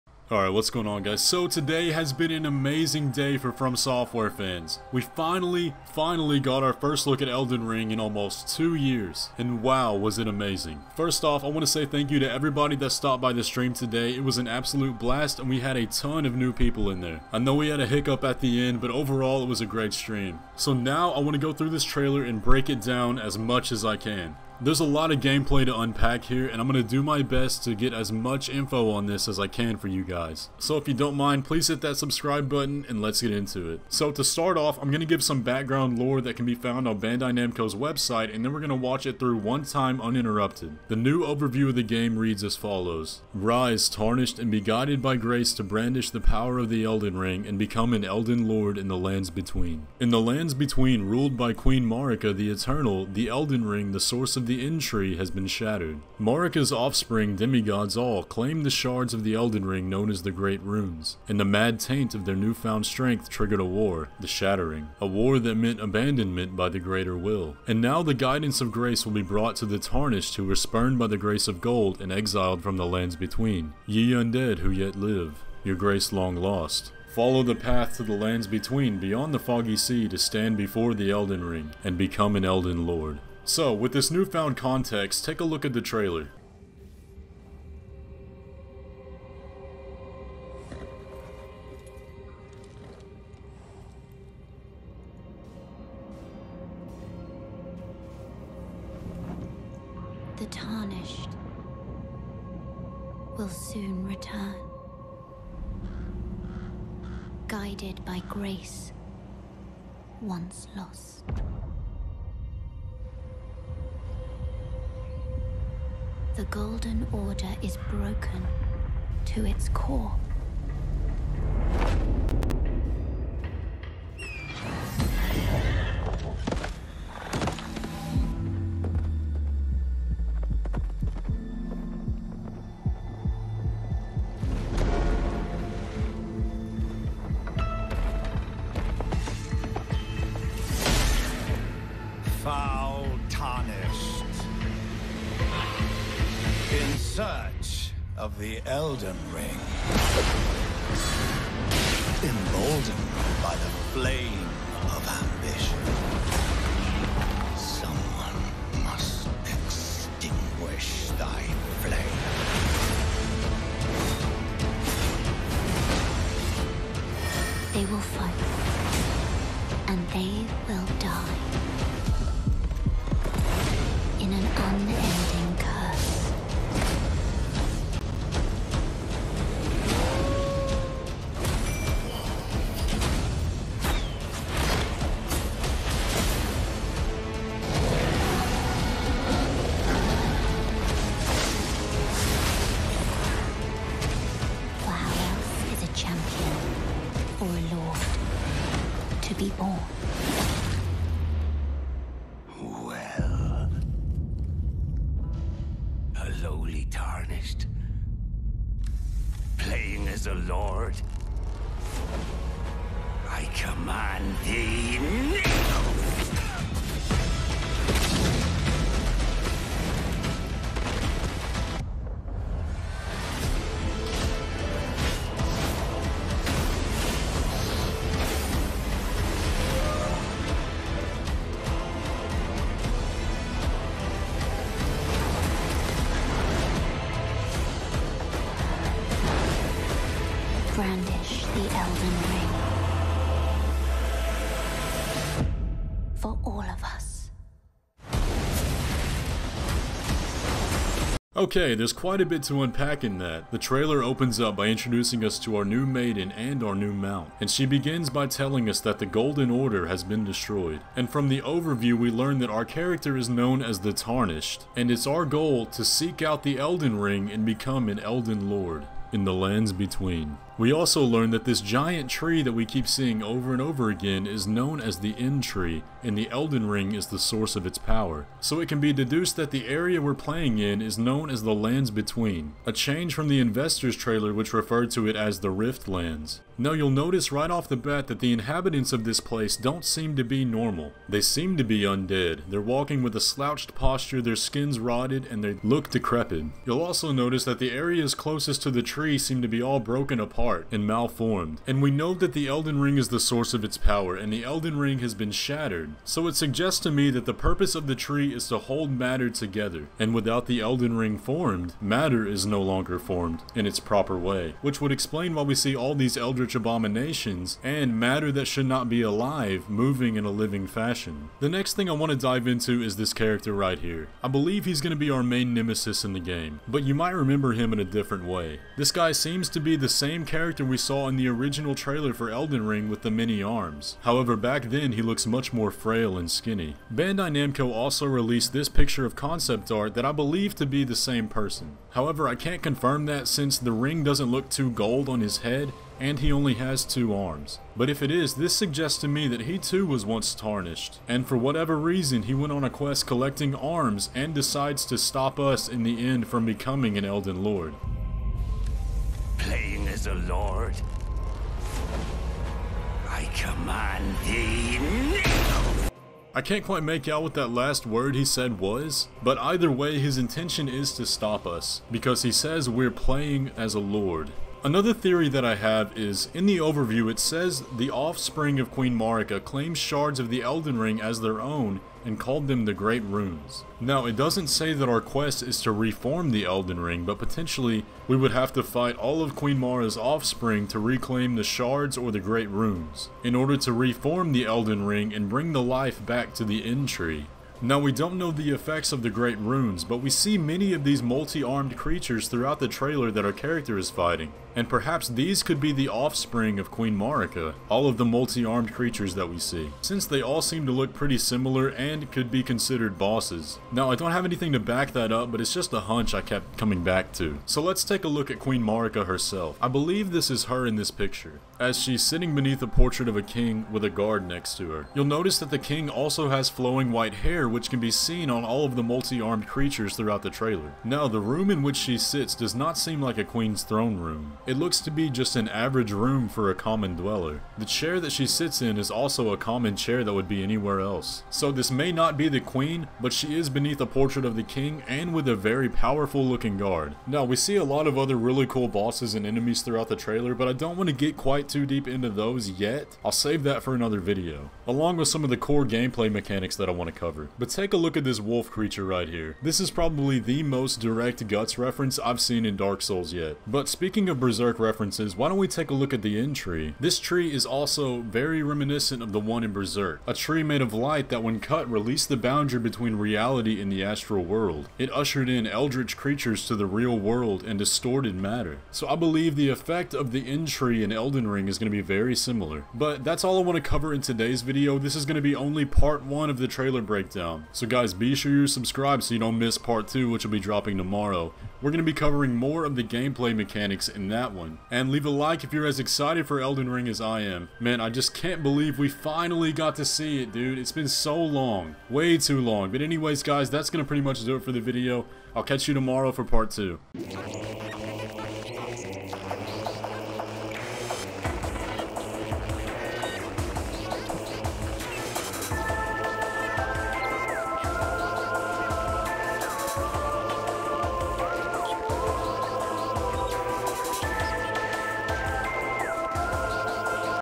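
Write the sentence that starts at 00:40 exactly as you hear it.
The new overview of the game reads as follows.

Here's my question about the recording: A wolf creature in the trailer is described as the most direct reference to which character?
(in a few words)
Guts.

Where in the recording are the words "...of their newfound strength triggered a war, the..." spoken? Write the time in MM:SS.
01:02.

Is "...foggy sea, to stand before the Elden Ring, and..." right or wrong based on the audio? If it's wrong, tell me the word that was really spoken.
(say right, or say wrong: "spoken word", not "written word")
right.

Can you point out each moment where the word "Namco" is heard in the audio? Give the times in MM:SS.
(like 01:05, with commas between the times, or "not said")
00:37, 05:37.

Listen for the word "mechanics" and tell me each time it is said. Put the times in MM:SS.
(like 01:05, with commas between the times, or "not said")
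07:36, 08:13.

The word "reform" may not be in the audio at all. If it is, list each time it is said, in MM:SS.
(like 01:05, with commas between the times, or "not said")
06:25, 06:33.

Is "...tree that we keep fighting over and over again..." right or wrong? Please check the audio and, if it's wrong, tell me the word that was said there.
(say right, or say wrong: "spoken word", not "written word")
wrong: "seeing", not "fighting".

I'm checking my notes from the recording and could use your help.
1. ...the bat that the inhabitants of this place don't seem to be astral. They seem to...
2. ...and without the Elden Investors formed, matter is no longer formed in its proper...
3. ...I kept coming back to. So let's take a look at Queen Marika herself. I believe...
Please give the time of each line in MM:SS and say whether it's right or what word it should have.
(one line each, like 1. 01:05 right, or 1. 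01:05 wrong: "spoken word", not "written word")
1. 04:47 wrong: "normal", not "astral"
2. 05:09 wrong: "Ring", not "Investors"
3. 06:56 right.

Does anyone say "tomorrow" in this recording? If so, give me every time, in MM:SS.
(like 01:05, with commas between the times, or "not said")
08:10, 08:25.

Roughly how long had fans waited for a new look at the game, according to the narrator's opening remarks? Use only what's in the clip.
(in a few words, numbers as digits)
almost two years.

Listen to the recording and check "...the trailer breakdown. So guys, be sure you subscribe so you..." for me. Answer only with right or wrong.
right.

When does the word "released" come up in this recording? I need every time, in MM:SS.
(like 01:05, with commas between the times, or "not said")
05:38, 07:51.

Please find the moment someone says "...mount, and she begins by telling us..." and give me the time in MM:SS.
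04:16.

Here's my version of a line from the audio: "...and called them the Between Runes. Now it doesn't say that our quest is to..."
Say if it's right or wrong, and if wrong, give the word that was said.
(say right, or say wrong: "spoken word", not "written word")
wrong: "Great", not "Between".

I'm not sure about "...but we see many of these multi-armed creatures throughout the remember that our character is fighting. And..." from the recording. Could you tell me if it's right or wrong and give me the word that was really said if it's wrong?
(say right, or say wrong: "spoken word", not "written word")
wrong: "trailer", not "remember".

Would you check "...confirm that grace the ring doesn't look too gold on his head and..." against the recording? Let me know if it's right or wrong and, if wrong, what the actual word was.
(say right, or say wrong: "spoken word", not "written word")
wrong: "since", not "grace".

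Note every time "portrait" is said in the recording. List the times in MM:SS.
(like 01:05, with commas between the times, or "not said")
07:02, 07:23.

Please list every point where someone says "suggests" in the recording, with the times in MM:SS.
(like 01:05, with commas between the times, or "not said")
05:06, 05:48.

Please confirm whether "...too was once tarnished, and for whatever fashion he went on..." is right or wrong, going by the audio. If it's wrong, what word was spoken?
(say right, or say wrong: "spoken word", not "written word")
wrong: "reason", not "fashion".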